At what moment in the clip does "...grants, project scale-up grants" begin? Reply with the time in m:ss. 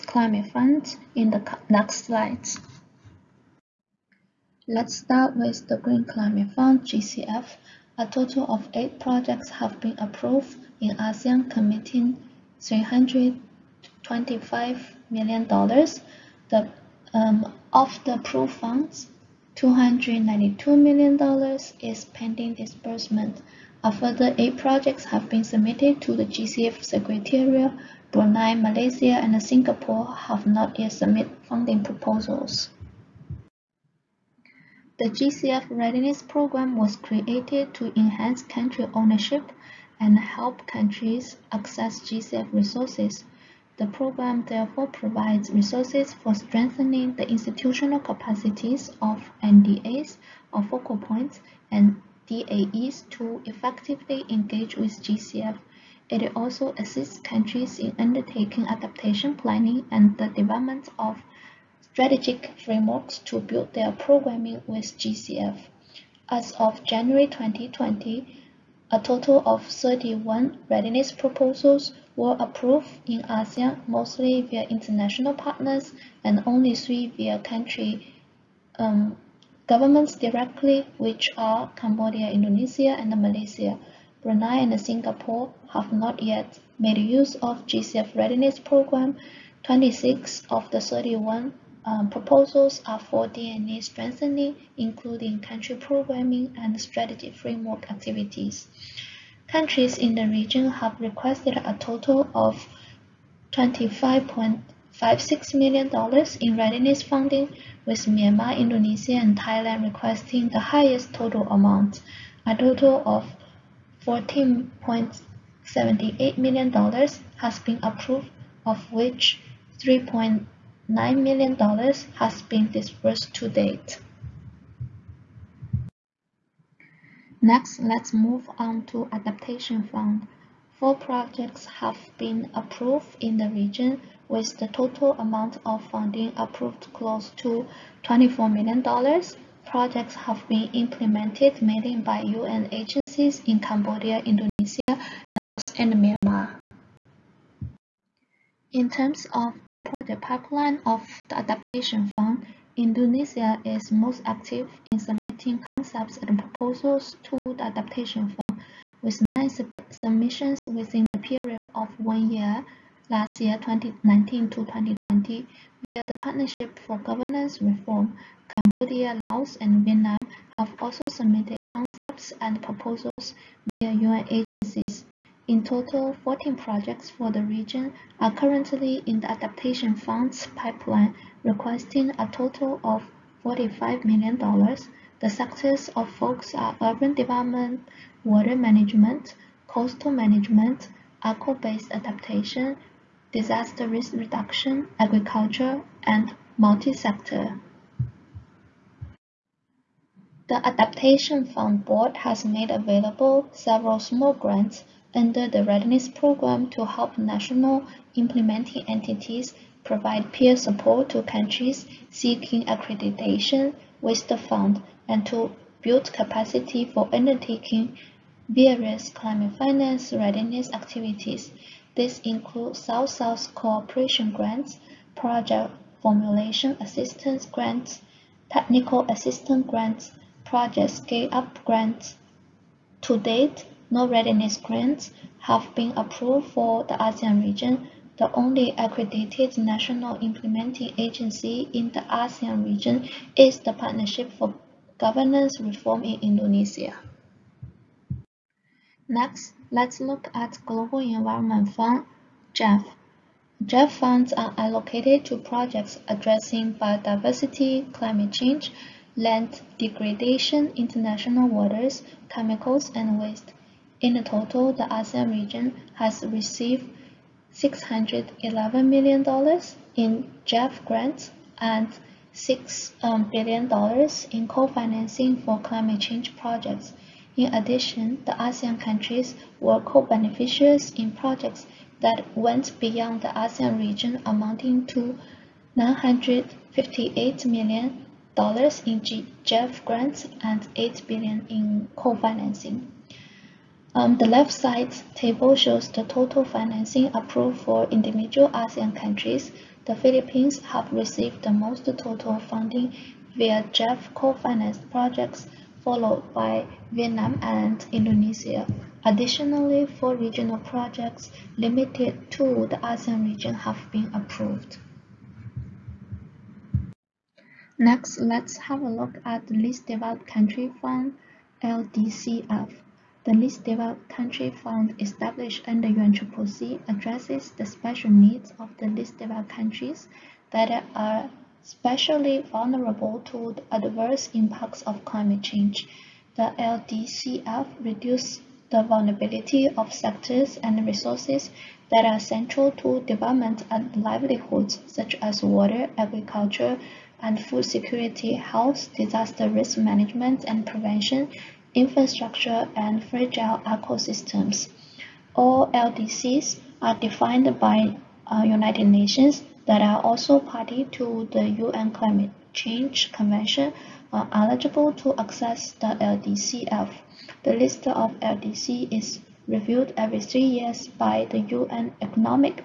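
3:49.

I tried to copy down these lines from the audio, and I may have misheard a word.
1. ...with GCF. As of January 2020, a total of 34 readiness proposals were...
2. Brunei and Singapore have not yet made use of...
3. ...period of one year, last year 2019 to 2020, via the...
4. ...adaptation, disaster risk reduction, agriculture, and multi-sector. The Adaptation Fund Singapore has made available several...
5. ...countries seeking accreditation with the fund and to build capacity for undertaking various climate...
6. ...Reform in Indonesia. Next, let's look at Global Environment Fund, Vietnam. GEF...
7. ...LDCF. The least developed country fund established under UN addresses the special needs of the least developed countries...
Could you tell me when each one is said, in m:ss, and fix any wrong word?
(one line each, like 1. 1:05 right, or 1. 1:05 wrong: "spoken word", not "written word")
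1. 1:04 wrong: "31", not "34"
2. 1:24 right
3. 2:41 right
4. 3:11 wrong: "Board", not "Singapore"
5. 3:31 right
6. 4:05 wrong: "GEF", not "Vietnam"
7. 5:21 right.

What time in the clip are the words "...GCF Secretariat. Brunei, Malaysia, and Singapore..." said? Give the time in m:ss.
0:26.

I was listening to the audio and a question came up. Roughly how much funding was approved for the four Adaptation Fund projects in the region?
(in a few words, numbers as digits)
close to $24 million.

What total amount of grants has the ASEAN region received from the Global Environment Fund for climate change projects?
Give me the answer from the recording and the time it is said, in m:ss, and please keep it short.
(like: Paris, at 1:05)
$611 million, at 4:27.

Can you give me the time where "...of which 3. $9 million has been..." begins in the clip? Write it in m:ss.
1:58.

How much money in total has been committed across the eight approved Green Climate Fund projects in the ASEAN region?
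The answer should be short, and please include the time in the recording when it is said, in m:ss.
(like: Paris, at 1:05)
$325 million, at 0:12.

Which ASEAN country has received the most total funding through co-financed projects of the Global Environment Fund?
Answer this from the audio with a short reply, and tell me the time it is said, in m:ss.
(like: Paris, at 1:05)
The Philippines, at 4:59.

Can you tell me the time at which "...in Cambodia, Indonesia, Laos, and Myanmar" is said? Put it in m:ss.
2:23.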